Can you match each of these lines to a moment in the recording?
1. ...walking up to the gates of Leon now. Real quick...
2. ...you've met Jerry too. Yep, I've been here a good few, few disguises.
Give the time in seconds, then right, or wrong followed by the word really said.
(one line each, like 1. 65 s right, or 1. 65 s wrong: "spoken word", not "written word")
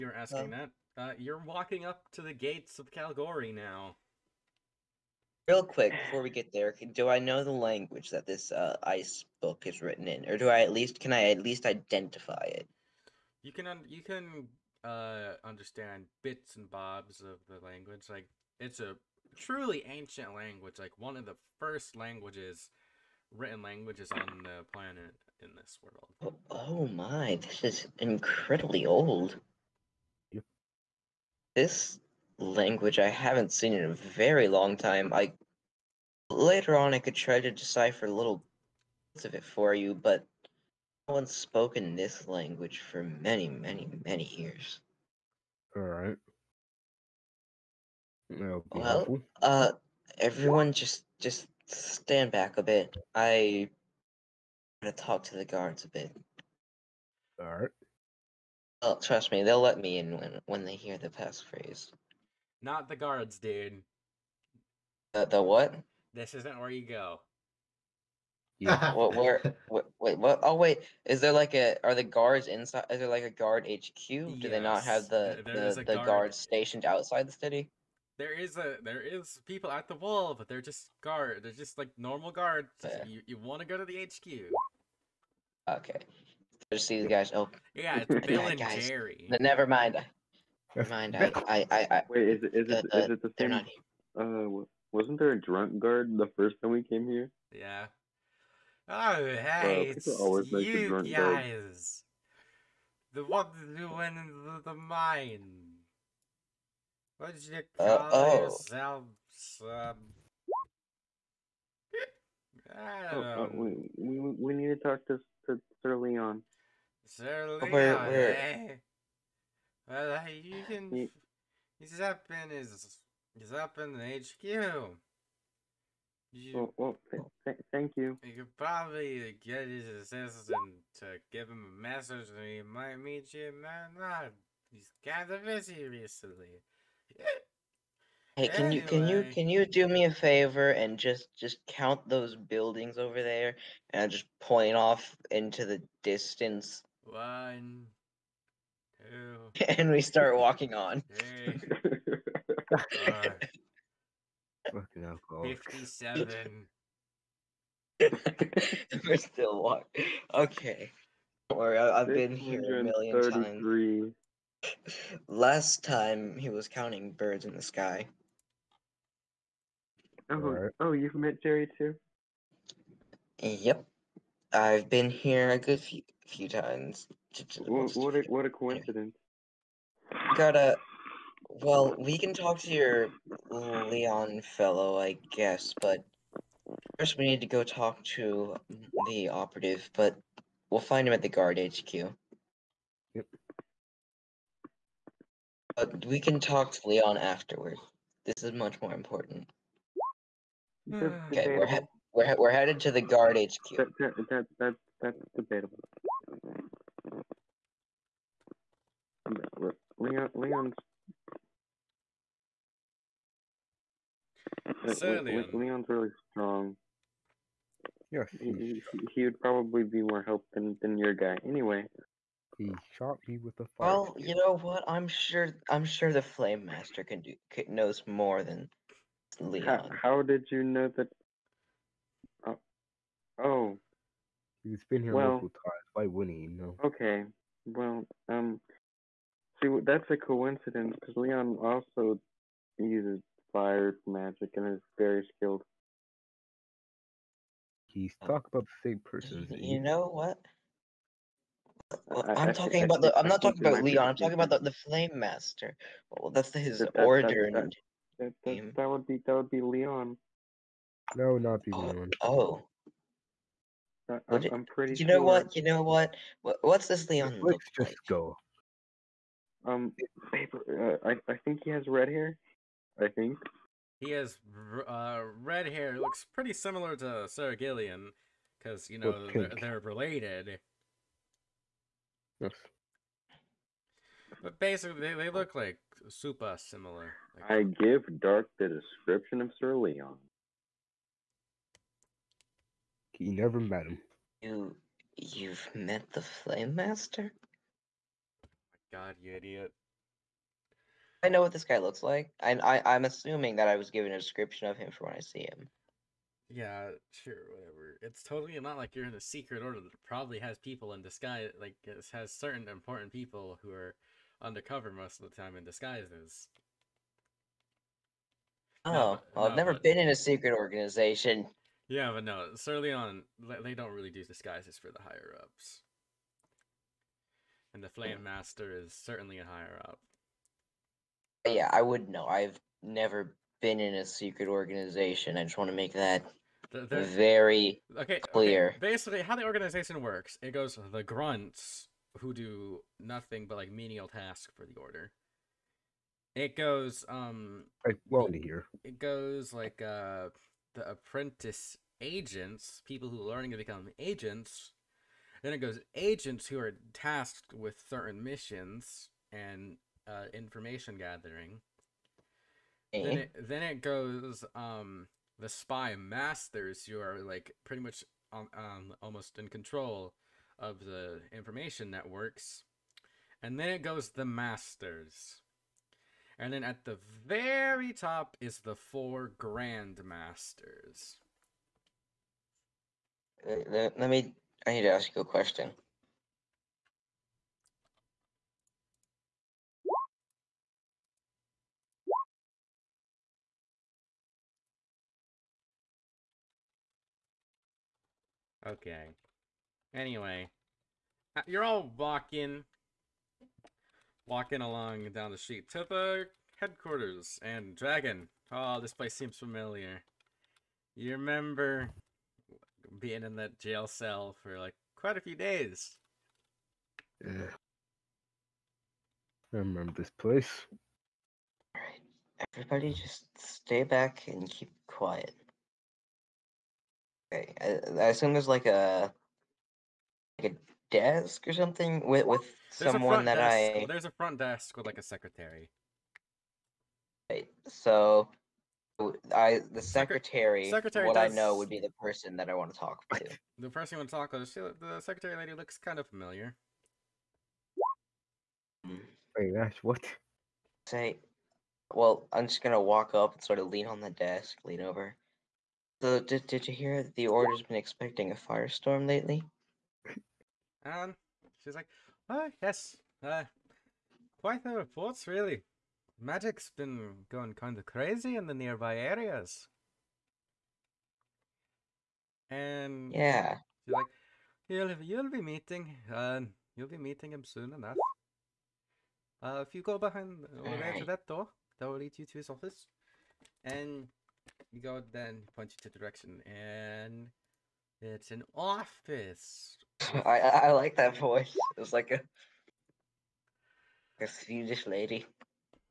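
1. 1 s wrong: "Calgary", not "Leon"
2. 170 s wrong: "times", not "disguises".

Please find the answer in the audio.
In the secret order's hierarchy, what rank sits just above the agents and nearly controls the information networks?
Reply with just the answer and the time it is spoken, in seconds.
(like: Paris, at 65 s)
spy masters, at 365 s.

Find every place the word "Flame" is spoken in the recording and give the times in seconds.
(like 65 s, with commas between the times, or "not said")
226 s, 254 s, 296 s, 327 s.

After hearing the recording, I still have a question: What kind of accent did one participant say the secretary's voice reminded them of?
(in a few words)
Swedish.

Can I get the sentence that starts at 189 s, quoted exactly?
But we'll find him at the guard HQ.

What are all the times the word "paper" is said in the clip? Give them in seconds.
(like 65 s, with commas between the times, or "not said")
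270 s.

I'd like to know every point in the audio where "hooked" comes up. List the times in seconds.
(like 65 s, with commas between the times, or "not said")
not said.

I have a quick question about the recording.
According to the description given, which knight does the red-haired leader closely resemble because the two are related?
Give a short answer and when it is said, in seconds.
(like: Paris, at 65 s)
Sir Gillian, at 277 s.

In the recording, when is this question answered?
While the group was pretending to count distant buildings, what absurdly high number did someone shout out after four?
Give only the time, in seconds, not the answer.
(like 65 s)
155 s.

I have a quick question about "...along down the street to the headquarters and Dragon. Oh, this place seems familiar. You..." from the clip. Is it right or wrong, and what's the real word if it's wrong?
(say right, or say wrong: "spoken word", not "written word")
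right.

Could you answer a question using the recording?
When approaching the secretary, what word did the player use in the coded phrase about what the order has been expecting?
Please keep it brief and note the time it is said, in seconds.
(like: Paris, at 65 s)
firestorm, at 458 s.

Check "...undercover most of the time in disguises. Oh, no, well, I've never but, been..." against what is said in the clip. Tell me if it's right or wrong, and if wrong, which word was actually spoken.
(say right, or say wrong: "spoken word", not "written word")
right.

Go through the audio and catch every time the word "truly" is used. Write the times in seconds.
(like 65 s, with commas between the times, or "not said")
19 s.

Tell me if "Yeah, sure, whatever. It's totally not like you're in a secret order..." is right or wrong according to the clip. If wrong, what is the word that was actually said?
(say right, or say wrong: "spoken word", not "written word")
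right.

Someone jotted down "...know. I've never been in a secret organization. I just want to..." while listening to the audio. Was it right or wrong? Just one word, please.
right.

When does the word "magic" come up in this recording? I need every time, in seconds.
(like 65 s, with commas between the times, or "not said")
244 s, 466 s.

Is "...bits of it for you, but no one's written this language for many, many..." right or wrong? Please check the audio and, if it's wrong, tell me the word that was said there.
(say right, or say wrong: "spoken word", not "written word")
wrong: "spoken", not "written".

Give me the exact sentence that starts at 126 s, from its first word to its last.
You, well, well th th thank you.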